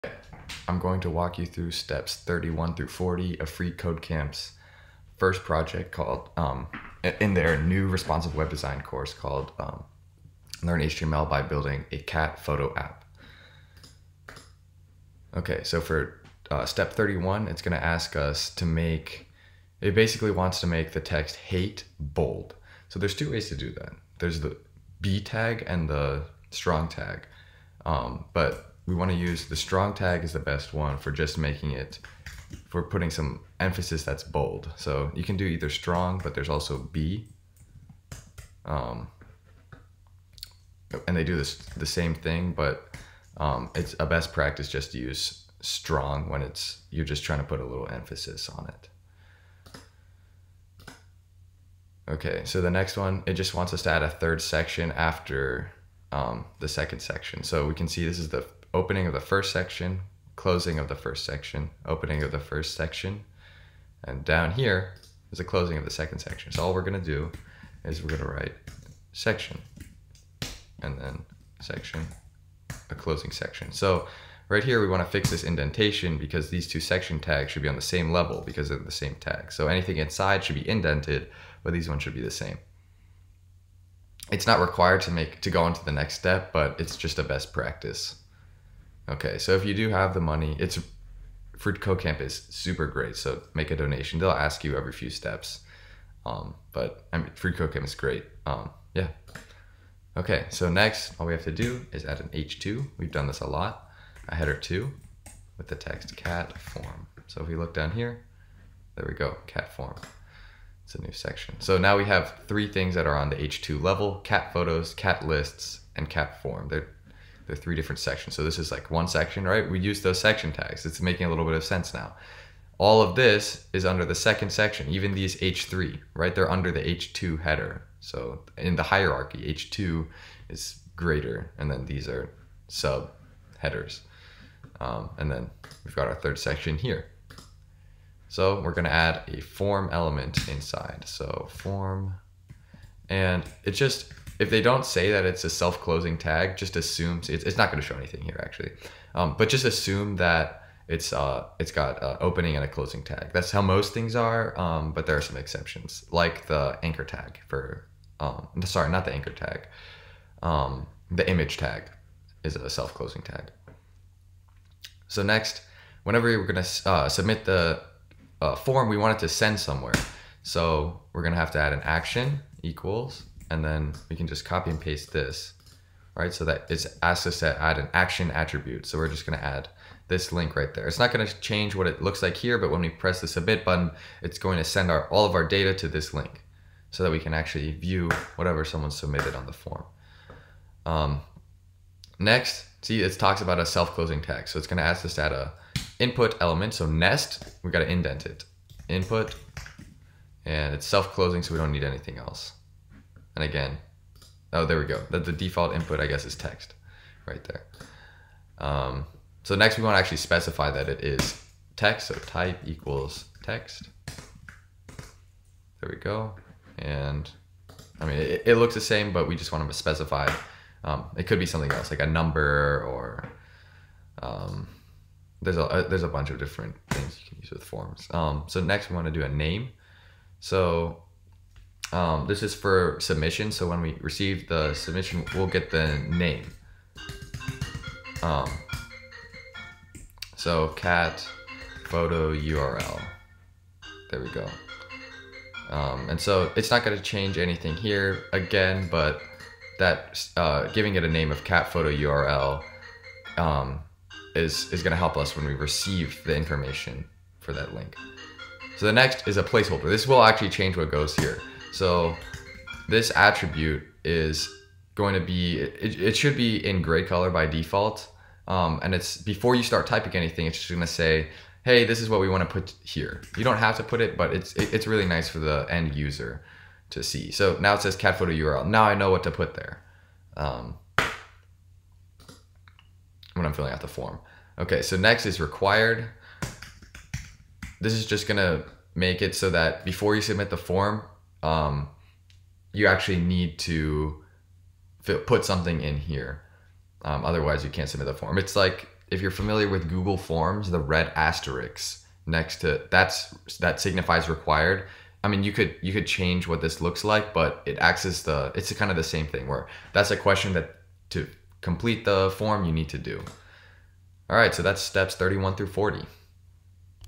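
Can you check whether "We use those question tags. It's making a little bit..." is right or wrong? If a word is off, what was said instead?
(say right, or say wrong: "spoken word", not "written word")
wrong: "section", not "question".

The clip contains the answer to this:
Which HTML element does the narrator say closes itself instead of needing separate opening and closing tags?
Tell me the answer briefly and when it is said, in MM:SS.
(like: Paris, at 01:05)
image tag, at 02:41.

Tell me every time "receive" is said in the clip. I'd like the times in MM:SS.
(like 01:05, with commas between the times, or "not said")
03:53, 04:15.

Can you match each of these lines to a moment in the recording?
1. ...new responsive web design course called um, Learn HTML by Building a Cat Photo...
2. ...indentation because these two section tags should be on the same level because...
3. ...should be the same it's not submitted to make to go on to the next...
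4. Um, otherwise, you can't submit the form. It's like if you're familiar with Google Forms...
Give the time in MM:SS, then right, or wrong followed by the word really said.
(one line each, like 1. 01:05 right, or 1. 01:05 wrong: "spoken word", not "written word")
1. 00:07 right
2. 01:15 right
3. 01:22 wrong: "required", not "submitted"
4. 04:57 right.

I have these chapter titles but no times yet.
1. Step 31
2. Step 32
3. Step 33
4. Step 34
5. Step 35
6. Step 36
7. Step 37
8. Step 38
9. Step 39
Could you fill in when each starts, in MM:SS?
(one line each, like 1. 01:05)
1. 00:15
2. 00:51
3. 01:27
4. 02:18
5. 02:43
6. 03:09
7. 03:28
8. 03:48
9. 04:17.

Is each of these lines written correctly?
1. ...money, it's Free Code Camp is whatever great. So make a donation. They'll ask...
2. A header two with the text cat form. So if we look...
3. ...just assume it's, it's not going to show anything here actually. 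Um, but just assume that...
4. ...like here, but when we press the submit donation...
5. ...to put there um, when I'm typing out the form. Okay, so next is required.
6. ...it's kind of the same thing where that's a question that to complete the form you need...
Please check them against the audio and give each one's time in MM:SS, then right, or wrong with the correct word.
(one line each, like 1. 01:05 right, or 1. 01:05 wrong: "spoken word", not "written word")
1. 01:30 wrong: "super", not "whatever"
2. 01:44 right
3. 02:26 right
4. 03:02 wrong: "button", not "donation"
5. 04:39 wrong: "filling", not "typing"
6. 05:08 right.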